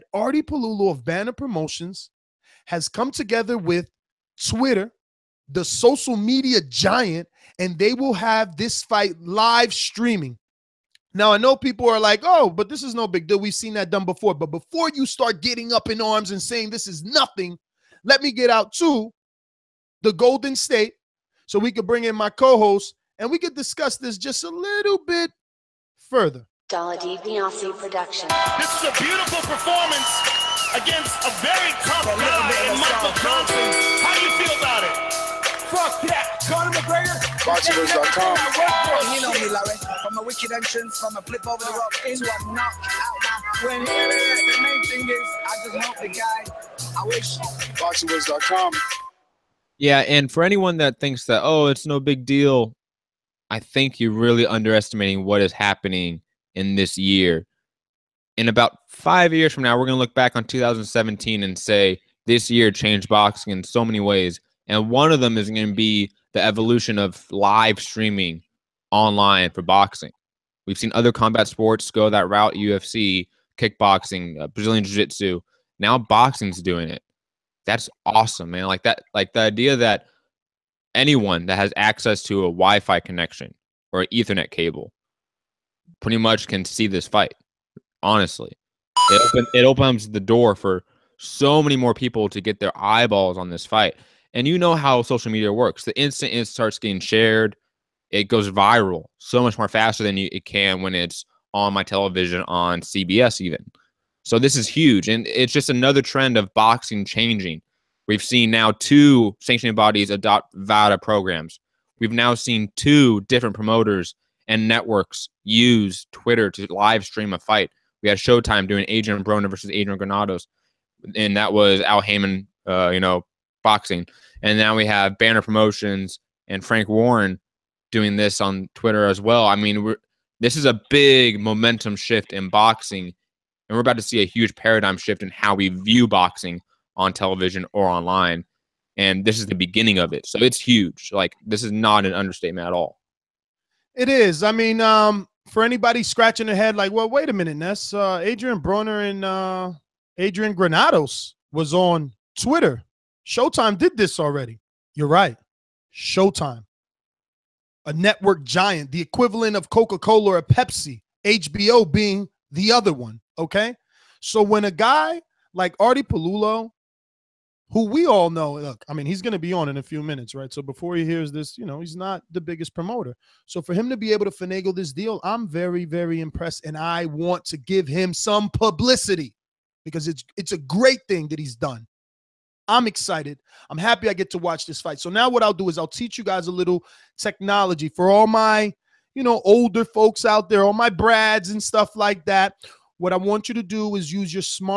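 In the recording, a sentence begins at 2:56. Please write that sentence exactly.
And I want to give him some publicity because it's it's a great thing that he's done.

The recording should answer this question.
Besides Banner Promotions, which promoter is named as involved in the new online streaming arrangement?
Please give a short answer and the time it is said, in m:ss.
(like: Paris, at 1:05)
Frank Warren, at 2:06.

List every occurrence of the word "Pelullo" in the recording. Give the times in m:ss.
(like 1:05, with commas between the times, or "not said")
0:00, 2:46.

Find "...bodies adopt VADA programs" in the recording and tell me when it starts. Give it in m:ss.
1:49.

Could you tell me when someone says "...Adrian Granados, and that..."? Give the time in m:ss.
1:59.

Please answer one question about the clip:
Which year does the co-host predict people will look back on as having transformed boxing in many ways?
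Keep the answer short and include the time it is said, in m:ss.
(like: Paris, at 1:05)
2017, at 1:00.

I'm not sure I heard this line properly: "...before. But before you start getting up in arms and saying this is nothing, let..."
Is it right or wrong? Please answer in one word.
right.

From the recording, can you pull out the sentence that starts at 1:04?
And one of them is going to be the evolution of live streaming online for boxing.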